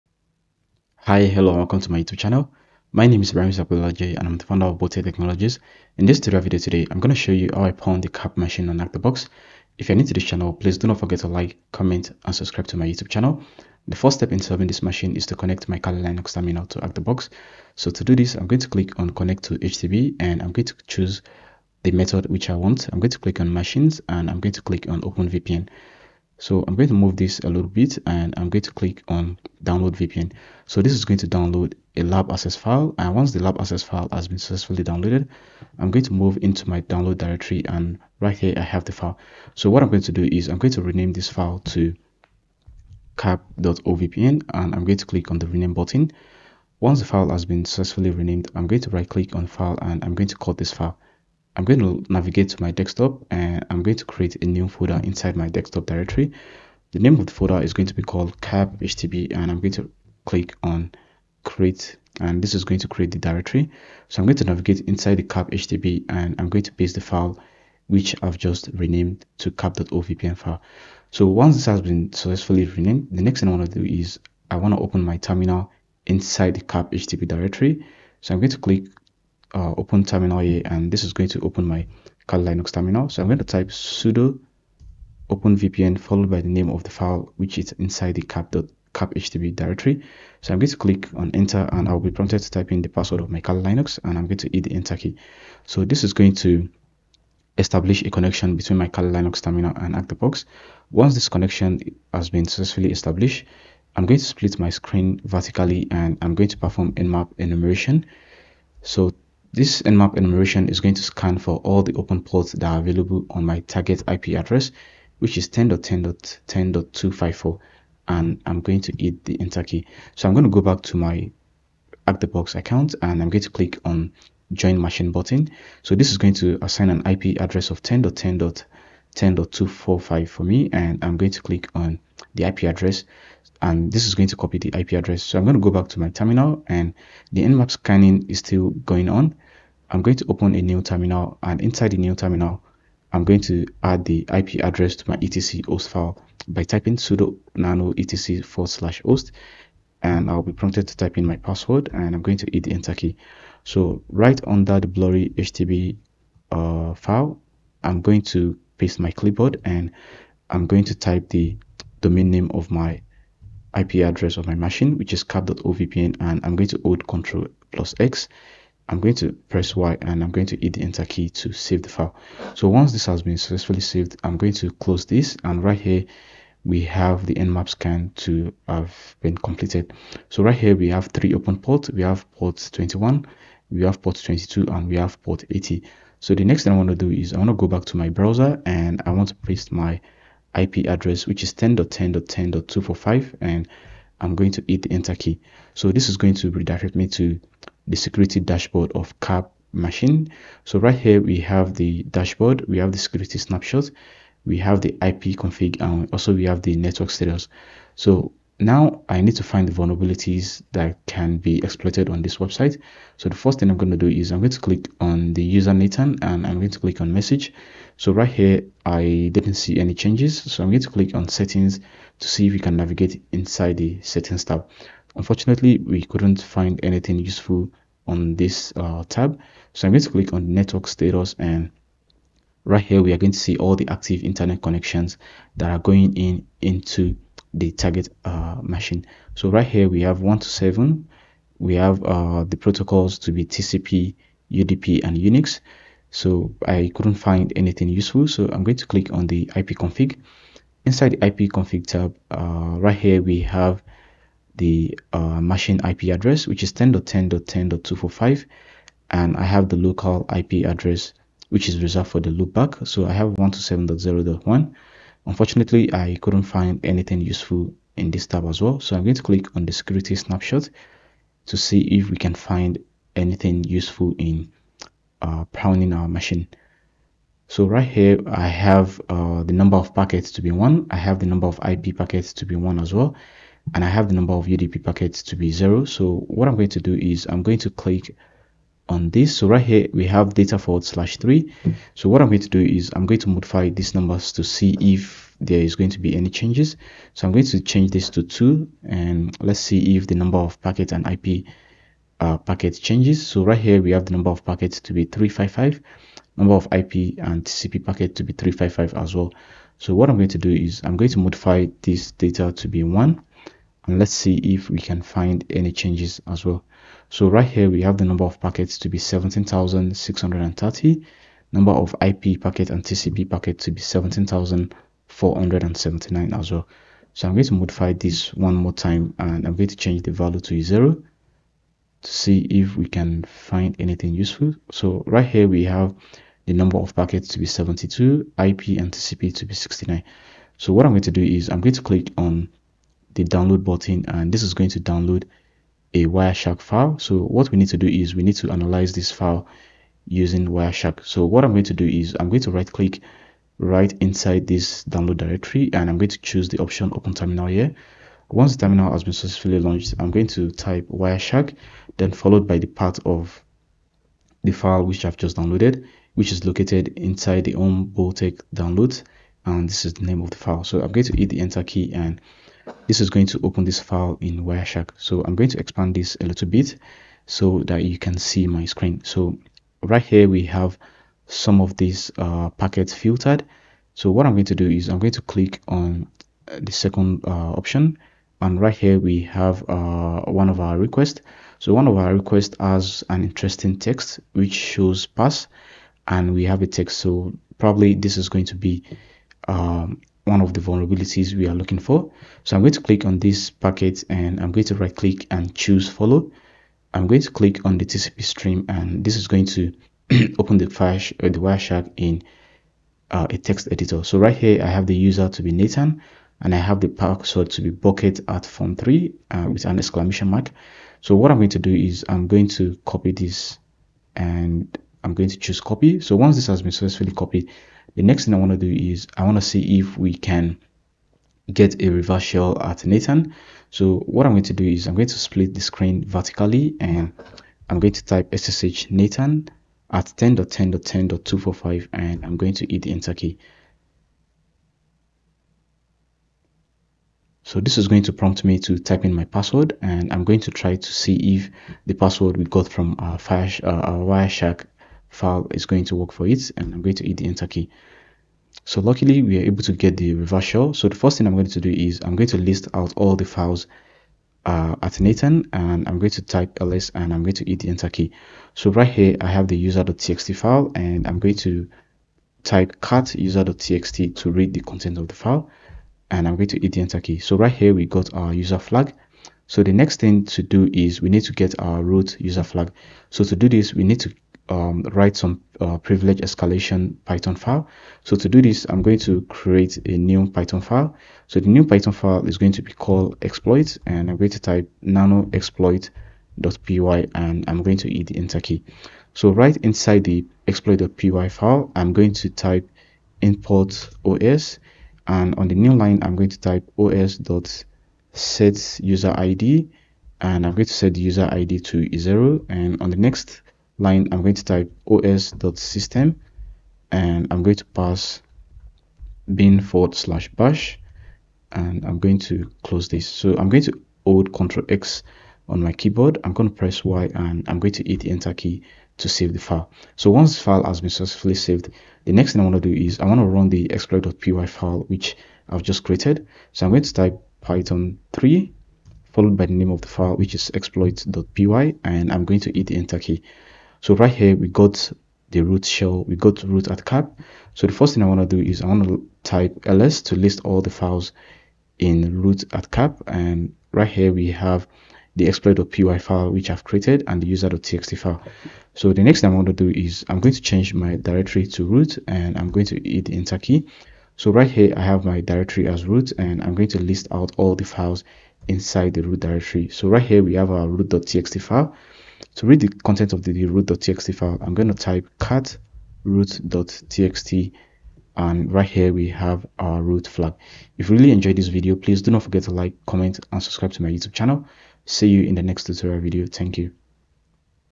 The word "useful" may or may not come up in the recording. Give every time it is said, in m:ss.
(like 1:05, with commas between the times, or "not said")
3:47, 4:07, 4:27, 4:33, 5:34.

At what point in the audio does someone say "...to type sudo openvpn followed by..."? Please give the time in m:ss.
1:23.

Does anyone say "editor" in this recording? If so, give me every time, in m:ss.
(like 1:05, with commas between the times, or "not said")
6:53.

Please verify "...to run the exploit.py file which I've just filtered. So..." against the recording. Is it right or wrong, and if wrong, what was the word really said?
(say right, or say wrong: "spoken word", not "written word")
wrong: "created", not "filtered".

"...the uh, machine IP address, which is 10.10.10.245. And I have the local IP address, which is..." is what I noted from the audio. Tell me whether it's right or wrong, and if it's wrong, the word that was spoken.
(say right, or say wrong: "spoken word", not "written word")
right.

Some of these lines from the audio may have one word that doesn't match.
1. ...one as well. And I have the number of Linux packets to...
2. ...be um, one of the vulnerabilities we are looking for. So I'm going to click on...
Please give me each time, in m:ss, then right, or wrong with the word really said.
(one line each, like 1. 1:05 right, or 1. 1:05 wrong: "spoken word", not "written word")
1. 4:42 wrong: "UDP", not "Linux"
2. 6:38 right.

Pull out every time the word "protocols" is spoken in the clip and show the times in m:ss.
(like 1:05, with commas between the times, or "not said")
4:02.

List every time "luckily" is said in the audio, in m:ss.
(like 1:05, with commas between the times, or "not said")
7:38.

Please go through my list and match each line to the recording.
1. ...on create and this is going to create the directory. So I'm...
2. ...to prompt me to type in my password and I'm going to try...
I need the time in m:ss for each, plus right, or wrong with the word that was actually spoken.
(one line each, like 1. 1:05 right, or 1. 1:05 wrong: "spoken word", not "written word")
1. 1:00 right
2. 7:28 right.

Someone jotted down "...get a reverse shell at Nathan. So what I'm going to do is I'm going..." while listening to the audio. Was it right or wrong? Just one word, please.
right.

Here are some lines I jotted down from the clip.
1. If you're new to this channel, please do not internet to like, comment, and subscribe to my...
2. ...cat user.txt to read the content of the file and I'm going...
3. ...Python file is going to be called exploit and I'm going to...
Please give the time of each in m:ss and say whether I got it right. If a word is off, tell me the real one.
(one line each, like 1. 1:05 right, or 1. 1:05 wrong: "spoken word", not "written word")
1. 0:09 wrong: "forget", not "internet"
2. 7:52 right
3. 8:11 right.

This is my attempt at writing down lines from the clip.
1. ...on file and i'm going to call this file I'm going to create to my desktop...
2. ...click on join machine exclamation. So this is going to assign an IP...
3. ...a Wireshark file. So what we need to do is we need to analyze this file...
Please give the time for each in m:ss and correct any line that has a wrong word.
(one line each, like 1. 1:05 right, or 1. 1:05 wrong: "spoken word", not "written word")
1. 0:49 wrong: "navigate", not "create"
2. 2:03 wrong: "button", not "exclamation"
3. 5:45 right.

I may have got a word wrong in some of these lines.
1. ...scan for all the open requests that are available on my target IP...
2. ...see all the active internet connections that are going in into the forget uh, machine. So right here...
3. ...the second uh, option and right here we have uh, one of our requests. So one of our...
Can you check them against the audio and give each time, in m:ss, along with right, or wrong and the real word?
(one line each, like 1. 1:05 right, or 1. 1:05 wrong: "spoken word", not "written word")
1. 1:51 wrong: "ports", not "requests"
2. 3:53 wrong: "target", not "forget"
3. 6:26 right.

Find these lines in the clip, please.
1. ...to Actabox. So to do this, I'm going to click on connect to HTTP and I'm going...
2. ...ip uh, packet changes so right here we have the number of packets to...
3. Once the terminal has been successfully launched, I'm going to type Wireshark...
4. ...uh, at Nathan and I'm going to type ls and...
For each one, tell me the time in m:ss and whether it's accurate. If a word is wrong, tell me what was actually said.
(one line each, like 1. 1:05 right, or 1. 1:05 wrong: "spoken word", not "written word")
1. 0:16 right
2. 5:01 right
3. 5:58 right
4. 7:44 right.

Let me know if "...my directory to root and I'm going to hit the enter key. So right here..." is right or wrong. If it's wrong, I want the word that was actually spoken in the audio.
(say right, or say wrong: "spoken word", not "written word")
right.